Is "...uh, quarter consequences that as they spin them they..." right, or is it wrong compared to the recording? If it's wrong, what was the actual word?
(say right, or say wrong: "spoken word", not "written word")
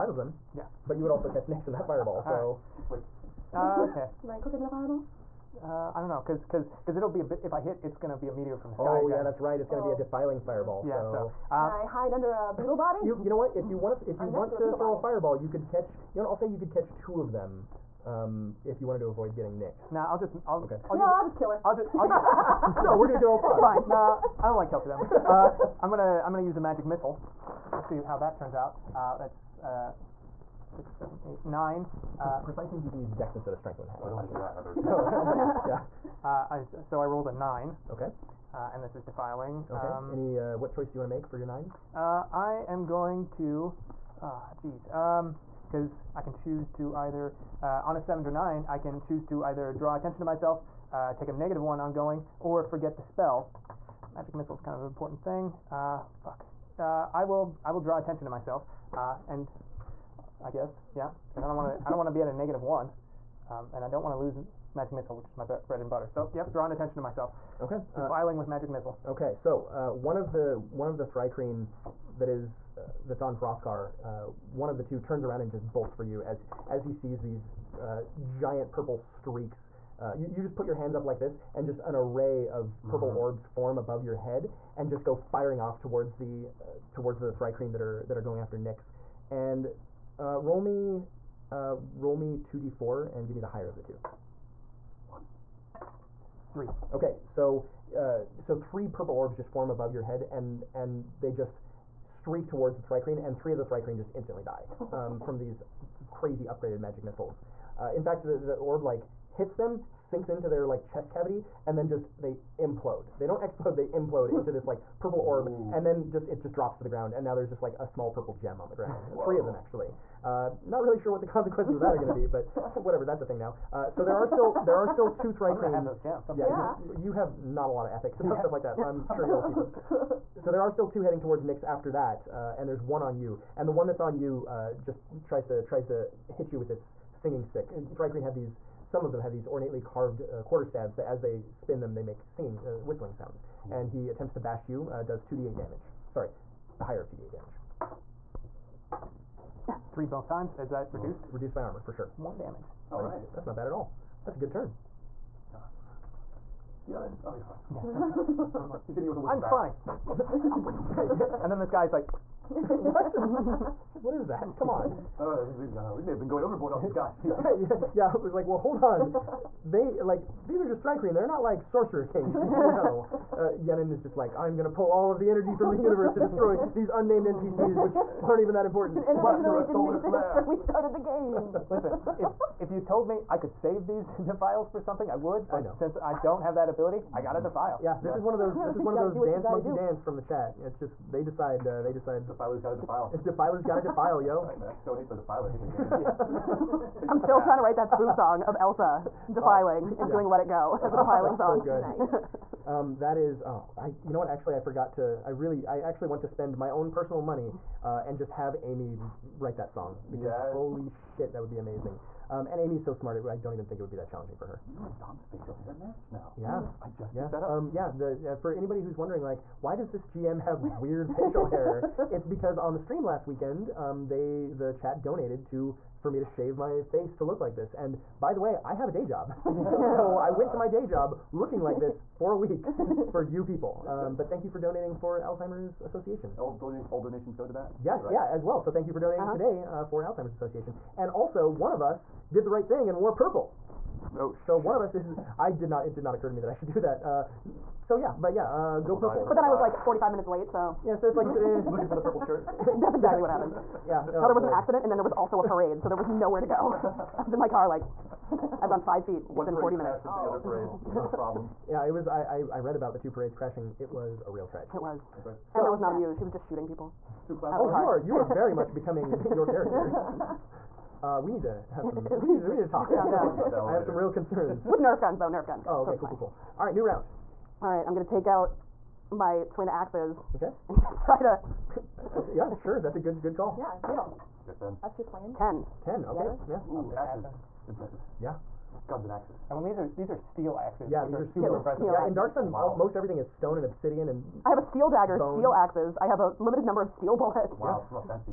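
wrong: "staves", not "consequences".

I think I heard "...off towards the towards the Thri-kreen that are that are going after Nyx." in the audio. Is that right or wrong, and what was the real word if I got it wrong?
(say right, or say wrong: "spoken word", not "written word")
right.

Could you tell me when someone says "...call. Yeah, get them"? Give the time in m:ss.
4:43.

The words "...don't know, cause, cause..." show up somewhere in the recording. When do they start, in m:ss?
0:06.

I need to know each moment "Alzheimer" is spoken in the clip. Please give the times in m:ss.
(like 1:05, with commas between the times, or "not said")
3:55, 4:00.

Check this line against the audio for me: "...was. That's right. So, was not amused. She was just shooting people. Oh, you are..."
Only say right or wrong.
right.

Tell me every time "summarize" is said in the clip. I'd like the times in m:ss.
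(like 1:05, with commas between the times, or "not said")
not said.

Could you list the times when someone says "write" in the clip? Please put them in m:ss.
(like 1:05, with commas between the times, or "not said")
3:17, 3:29.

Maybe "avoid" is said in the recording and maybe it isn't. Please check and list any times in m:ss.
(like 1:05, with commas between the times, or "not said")
0:19.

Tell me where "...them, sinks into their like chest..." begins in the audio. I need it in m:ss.
1:49.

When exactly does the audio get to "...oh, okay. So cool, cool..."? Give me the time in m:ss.
4:35.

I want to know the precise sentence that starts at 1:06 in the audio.
So, yep, drawing attention to myself.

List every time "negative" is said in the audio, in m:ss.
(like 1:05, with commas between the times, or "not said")
0:51, 1:02.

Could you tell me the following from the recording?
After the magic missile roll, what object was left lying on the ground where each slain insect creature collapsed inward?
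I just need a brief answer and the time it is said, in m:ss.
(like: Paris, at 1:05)
Small purple gem, at 1:57.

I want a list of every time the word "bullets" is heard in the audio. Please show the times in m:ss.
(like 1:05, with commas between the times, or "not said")
4:57.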